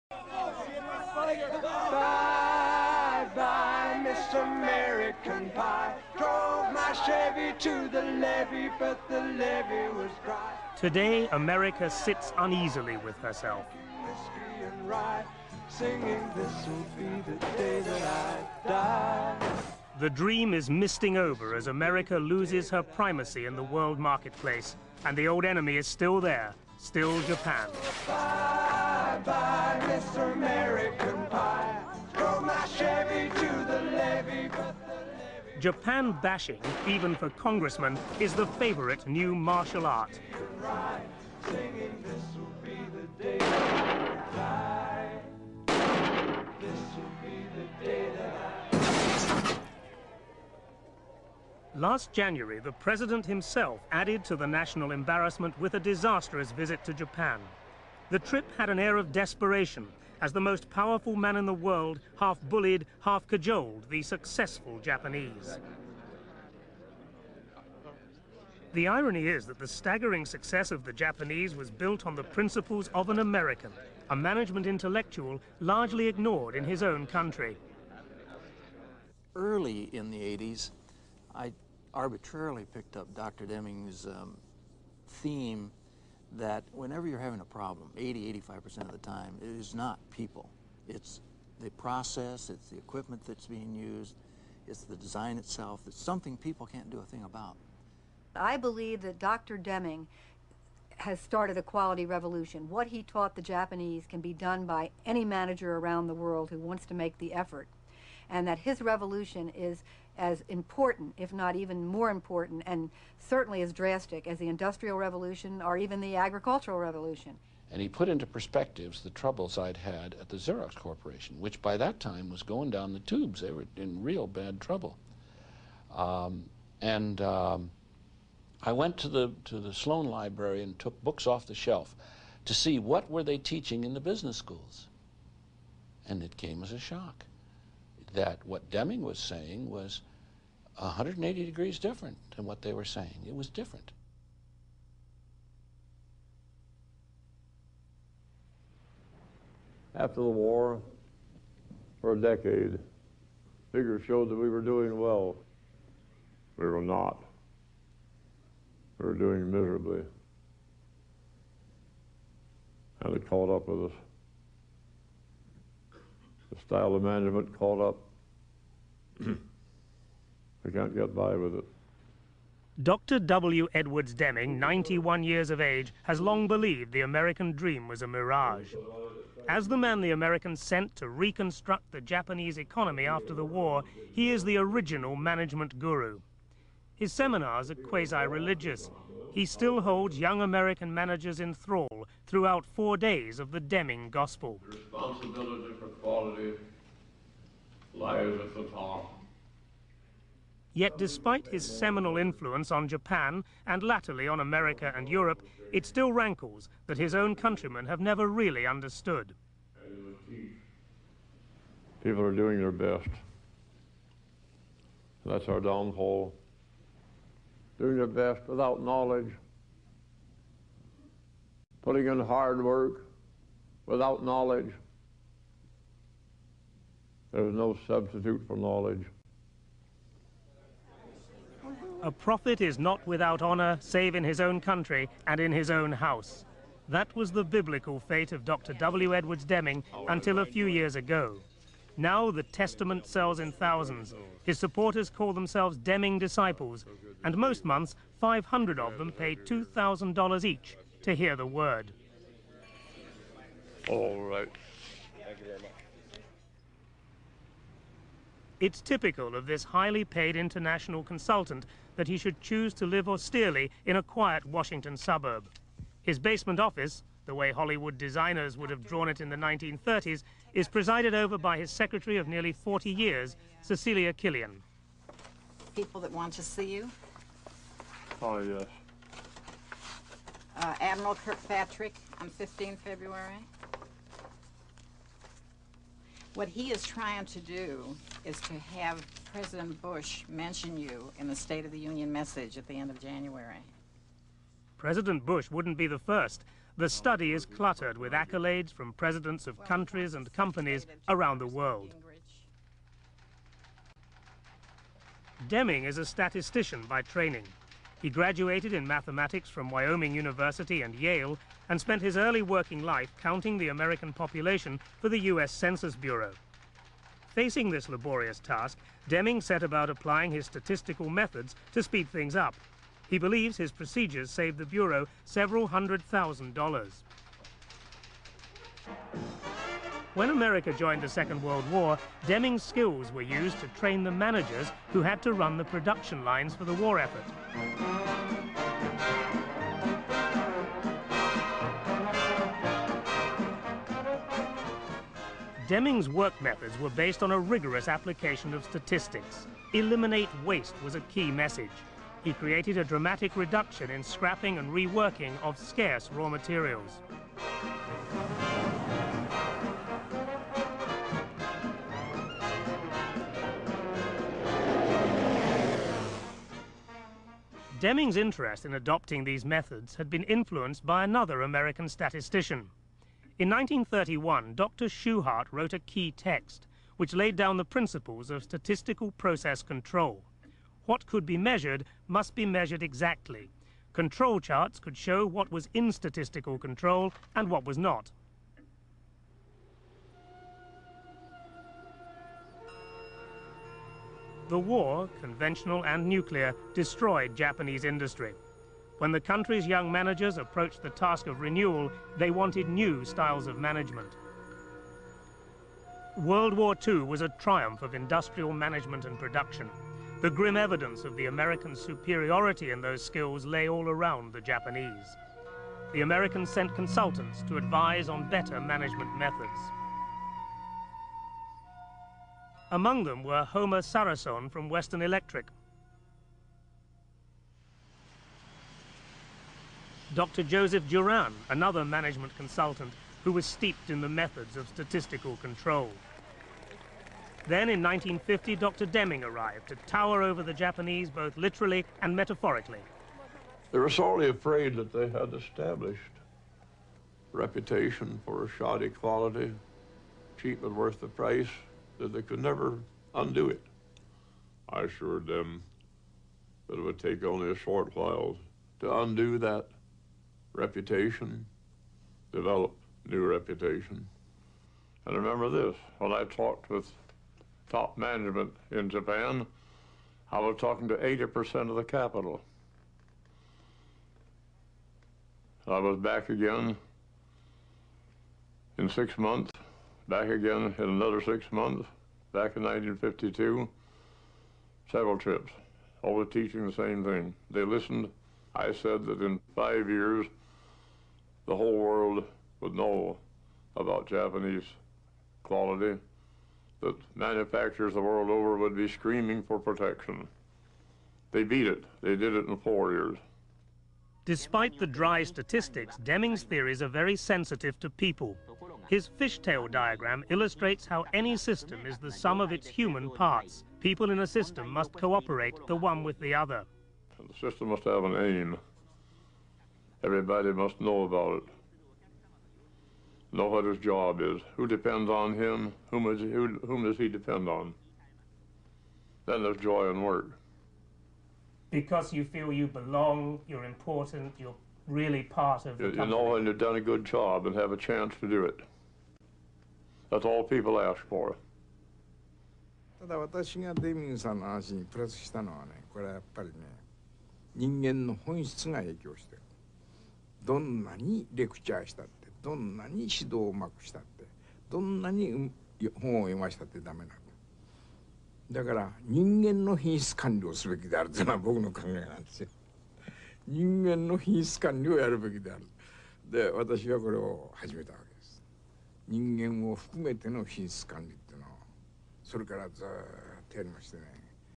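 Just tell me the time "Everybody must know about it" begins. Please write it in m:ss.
8:40.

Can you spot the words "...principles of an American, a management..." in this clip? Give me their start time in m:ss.
1:12.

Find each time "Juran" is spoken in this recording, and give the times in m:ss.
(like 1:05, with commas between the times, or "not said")
7:10.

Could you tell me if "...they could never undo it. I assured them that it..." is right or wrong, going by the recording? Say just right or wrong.
right.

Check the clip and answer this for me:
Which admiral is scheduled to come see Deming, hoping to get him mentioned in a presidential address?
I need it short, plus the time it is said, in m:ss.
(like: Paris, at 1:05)
Admiral Kirkpatrick, at 4:40.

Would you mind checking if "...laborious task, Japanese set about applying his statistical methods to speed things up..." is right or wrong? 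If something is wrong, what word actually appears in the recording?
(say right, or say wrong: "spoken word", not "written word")
wrong: "Deming", not "Japanese".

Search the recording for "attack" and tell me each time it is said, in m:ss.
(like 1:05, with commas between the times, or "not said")
not said.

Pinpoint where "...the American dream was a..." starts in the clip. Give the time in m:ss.
2:56.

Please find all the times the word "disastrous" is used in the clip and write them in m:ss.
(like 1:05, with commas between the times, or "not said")
0:55.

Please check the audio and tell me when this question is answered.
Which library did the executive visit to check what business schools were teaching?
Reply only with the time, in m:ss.
2:09.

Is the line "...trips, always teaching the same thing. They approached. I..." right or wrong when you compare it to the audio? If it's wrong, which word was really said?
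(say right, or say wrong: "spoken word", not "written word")
wrong: "listened", not "approached".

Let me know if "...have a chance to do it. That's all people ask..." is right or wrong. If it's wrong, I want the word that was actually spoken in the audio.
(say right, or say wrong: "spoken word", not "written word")
right.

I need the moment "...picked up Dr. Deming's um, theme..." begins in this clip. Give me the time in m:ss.
1:22.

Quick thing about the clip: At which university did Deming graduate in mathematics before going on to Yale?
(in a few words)
Wyoming University.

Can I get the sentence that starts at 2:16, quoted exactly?
And it came as a shock that what Deming was saying was 180 degrees different than what they were saying.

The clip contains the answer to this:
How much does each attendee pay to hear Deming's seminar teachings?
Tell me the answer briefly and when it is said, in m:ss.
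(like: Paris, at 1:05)
$2,000, at 4:09.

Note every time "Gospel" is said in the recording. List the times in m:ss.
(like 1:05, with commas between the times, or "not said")
3:14.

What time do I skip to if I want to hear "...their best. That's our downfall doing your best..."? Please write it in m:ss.
3:32.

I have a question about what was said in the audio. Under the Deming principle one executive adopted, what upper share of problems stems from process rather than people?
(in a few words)
85%.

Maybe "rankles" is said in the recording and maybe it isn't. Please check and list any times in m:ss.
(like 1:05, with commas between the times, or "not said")
3:26.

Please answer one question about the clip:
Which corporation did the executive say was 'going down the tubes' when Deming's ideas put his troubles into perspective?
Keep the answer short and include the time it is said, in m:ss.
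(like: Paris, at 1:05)
Xerox, at 2:00.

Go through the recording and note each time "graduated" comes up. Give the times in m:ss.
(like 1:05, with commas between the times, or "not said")
5:08.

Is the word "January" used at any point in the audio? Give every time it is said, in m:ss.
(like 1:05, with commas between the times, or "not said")
0:52, 4:52.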